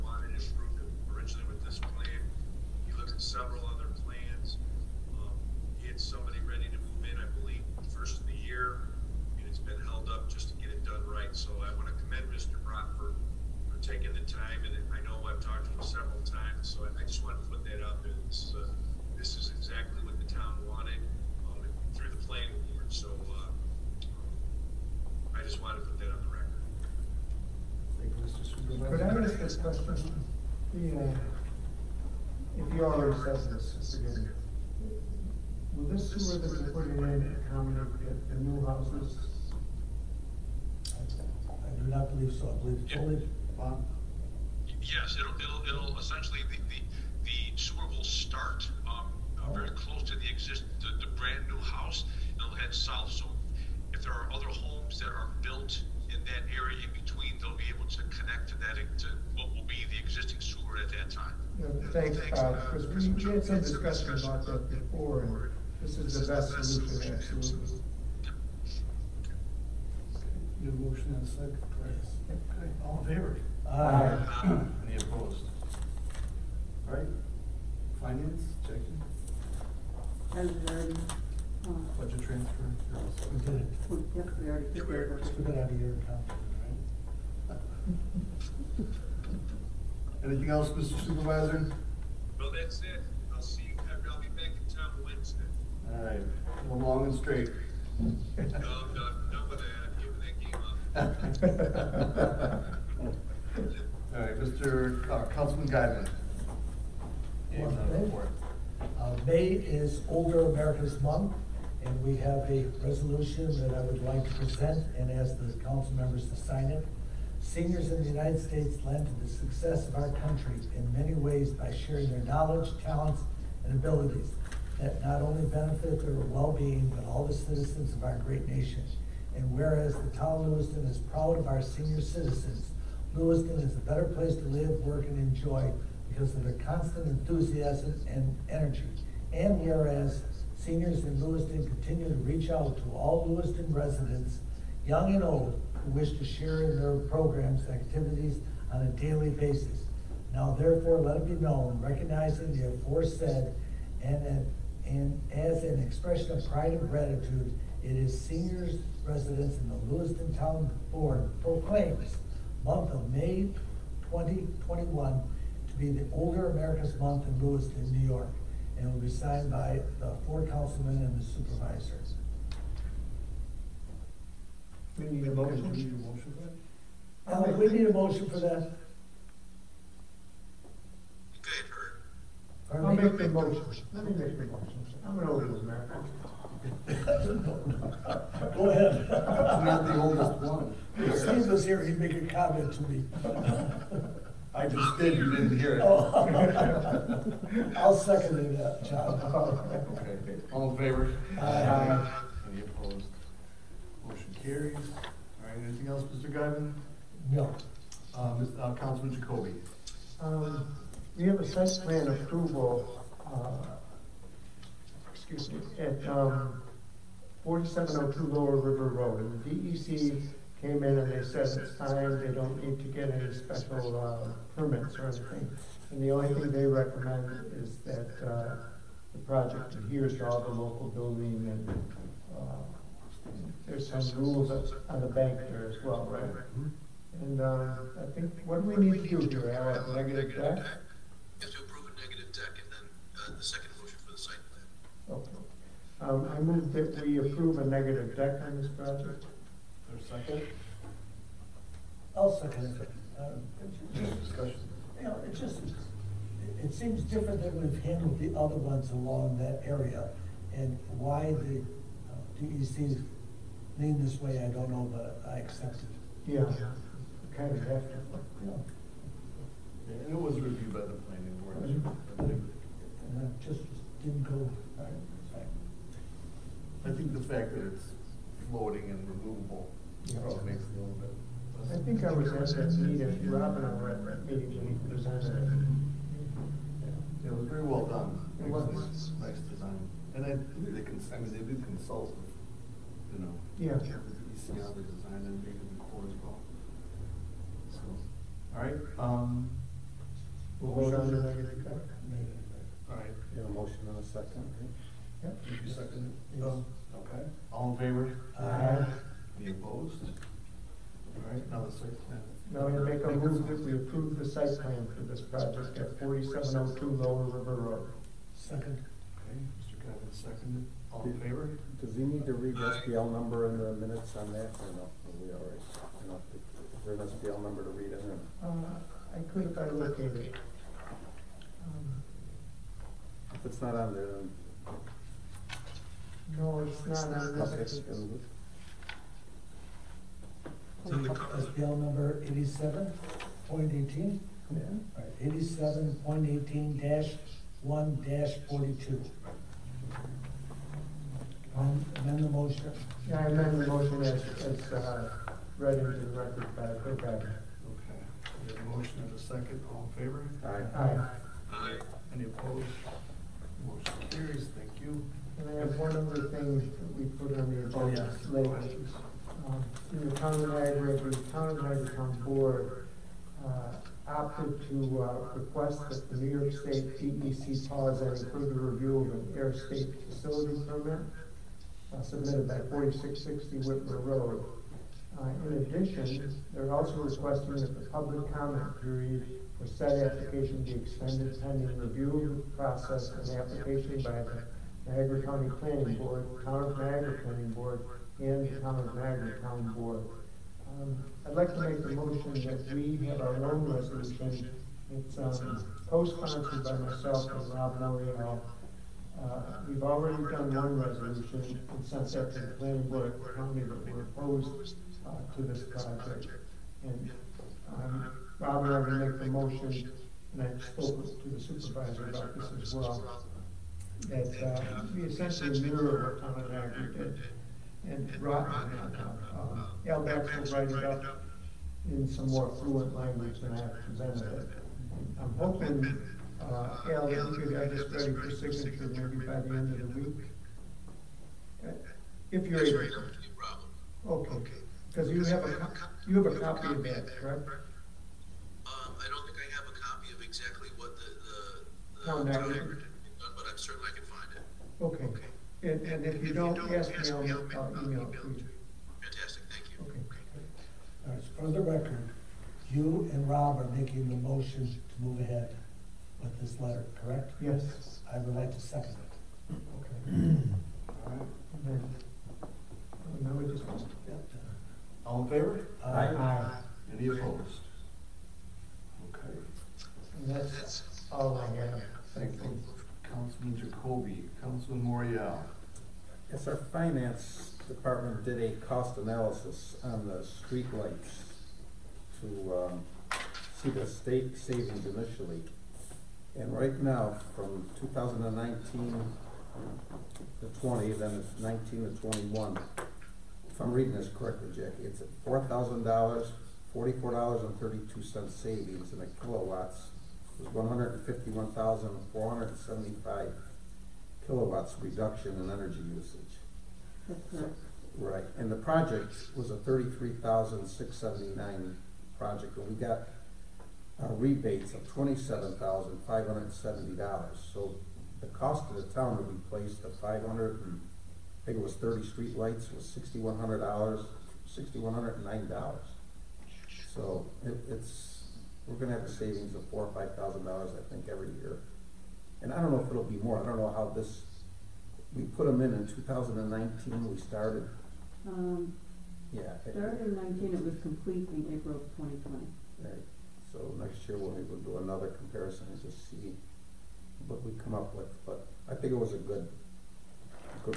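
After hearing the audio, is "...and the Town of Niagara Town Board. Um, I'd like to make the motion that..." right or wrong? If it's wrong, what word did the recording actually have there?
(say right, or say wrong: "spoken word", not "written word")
right.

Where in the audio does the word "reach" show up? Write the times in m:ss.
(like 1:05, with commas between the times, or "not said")
2:22.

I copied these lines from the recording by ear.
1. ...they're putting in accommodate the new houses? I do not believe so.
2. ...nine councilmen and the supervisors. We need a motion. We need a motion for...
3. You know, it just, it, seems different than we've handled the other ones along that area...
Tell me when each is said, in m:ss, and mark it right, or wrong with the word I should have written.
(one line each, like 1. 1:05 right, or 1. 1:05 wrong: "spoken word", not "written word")
1. 0:36 right
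2. 2:50 wrong: "four", not "nine"
3. 4:14 right.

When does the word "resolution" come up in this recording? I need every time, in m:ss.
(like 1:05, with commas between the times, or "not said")
1:52, 6:43, 6:50.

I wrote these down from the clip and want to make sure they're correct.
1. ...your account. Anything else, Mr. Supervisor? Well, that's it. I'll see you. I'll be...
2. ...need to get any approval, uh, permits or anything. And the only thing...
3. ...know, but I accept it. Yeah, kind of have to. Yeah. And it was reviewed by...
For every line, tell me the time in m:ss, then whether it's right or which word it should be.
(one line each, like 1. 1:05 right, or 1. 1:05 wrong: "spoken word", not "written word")
1. 1:25 right
2. 3:42 wrong: "special", not "approval"
3. 4:24 right.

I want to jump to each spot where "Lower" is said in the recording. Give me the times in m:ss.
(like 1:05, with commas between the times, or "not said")
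3:38, 5:16.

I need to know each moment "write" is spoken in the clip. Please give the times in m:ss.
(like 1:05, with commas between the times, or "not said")
7:10.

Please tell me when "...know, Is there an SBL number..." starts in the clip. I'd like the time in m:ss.
5:26.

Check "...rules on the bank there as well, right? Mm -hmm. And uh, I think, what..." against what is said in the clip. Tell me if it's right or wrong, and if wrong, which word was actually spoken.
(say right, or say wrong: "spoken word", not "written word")
right.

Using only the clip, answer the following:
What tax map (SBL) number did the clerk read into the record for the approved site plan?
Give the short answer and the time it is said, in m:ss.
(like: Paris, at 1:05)
87.18-1-42, at 5:45.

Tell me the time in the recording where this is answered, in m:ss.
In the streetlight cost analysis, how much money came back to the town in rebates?
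8:44.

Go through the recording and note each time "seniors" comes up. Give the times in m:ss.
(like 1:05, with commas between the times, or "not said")
1:57, 2:11, 2:20, 2:38.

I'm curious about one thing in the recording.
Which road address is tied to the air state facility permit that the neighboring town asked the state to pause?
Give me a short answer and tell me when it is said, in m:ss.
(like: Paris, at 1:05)
4660 Witmer Road, at 6:22.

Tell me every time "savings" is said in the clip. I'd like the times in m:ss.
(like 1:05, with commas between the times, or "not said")
8:14, 8:59.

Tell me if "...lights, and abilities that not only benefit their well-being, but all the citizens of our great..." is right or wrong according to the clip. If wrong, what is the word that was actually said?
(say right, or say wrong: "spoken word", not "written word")
wrong: "talents", not "lights".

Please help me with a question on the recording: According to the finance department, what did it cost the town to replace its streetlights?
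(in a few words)
$6,109.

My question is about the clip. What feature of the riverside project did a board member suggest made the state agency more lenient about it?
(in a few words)
floating and removable.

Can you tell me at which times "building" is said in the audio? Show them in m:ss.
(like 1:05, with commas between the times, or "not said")
3:50.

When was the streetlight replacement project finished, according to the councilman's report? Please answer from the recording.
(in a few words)
April 2020.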